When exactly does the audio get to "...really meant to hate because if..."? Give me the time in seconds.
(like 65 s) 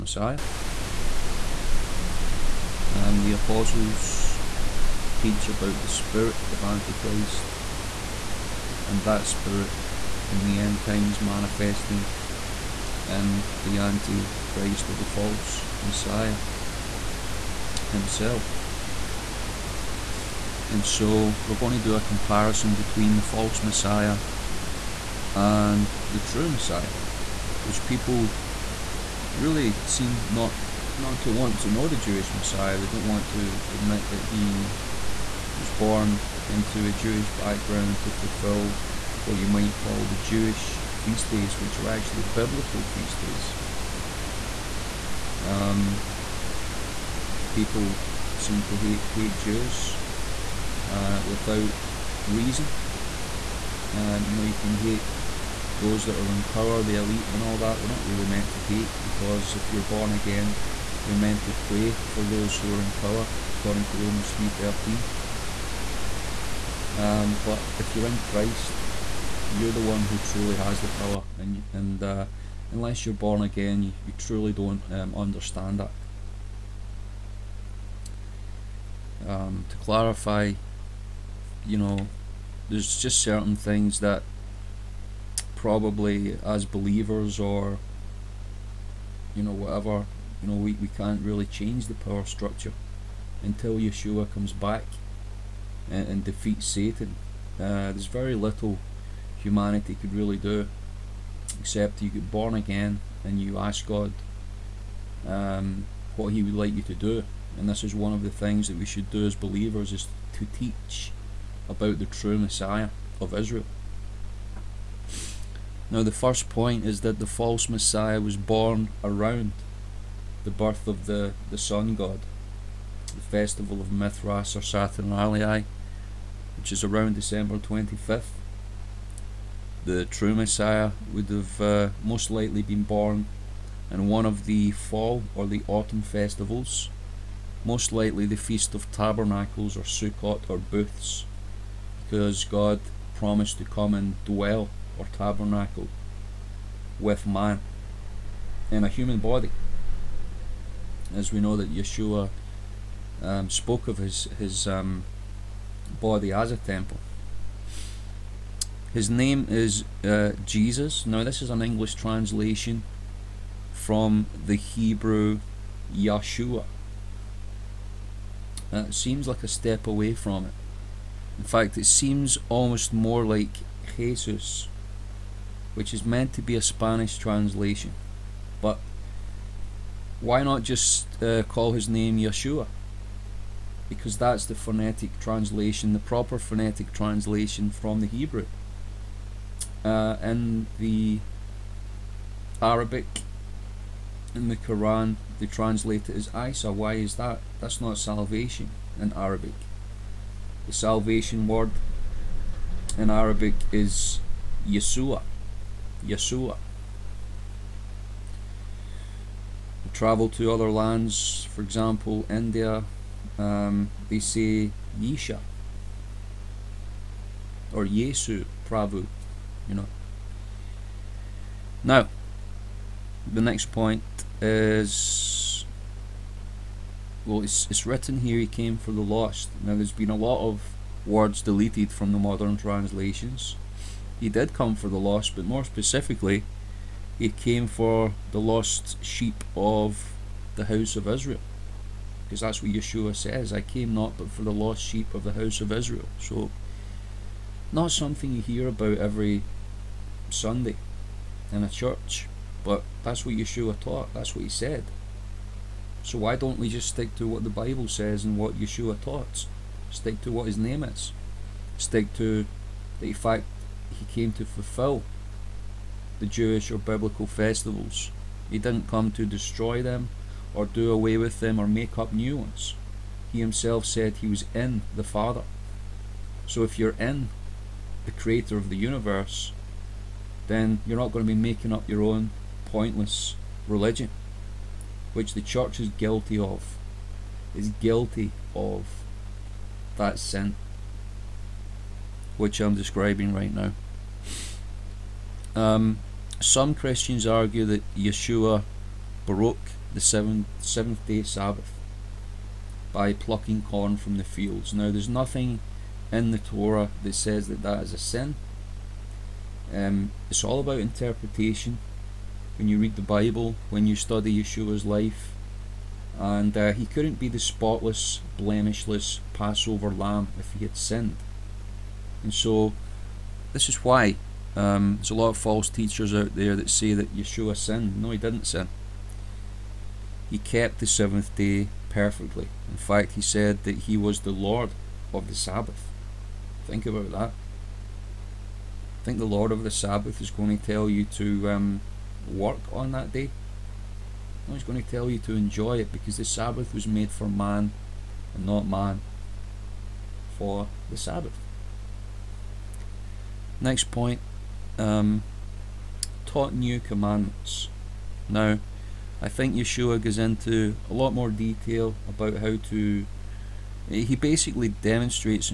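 58 s.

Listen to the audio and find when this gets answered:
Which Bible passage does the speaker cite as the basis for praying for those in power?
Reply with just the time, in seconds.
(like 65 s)
63 s.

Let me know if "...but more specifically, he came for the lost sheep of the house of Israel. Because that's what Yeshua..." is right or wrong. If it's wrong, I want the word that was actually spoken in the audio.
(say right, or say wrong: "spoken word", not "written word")
right.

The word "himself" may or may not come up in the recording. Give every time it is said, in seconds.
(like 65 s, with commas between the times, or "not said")
17 s, 273 s.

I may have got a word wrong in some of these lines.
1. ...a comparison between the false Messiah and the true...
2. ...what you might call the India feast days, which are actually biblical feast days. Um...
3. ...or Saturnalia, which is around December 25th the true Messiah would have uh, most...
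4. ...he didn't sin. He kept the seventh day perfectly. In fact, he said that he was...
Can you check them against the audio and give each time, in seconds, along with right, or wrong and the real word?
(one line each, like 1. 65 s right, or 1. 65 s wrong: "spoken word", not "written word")
1. 21 s right
2. 39 s wrong: "Jewish", not "India"
3. 124 s right
4. 328 s right.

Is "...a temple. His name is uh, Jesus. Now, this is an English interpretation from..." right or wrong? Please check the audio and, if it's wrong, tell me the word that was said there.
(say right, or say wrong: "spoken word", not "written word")
wrong: "translation", not "interpretation".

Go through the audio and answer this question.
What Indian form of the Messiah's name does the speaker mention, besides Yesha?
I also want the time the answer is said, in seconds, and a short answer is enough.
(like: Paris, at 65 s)
Yesu Prabhu, at 217 s.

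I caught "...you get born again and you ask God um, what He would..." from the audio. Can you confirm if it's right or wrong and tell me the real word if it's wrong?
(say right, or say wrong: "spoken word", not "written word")
right.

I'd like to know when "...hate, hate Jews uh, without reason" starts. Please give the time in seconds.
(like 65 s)
48 s.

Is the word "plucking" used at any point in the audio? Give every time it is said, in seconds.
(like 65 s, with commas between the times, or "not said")
303 s.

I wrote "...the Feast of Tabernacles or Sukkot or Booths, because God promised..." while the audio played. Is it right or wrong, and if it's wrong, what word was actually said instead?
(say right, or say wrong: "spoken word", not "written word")
right.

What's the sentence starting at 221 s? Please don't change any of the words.
Now, the next point is well, it's, it's written here he came for the lost.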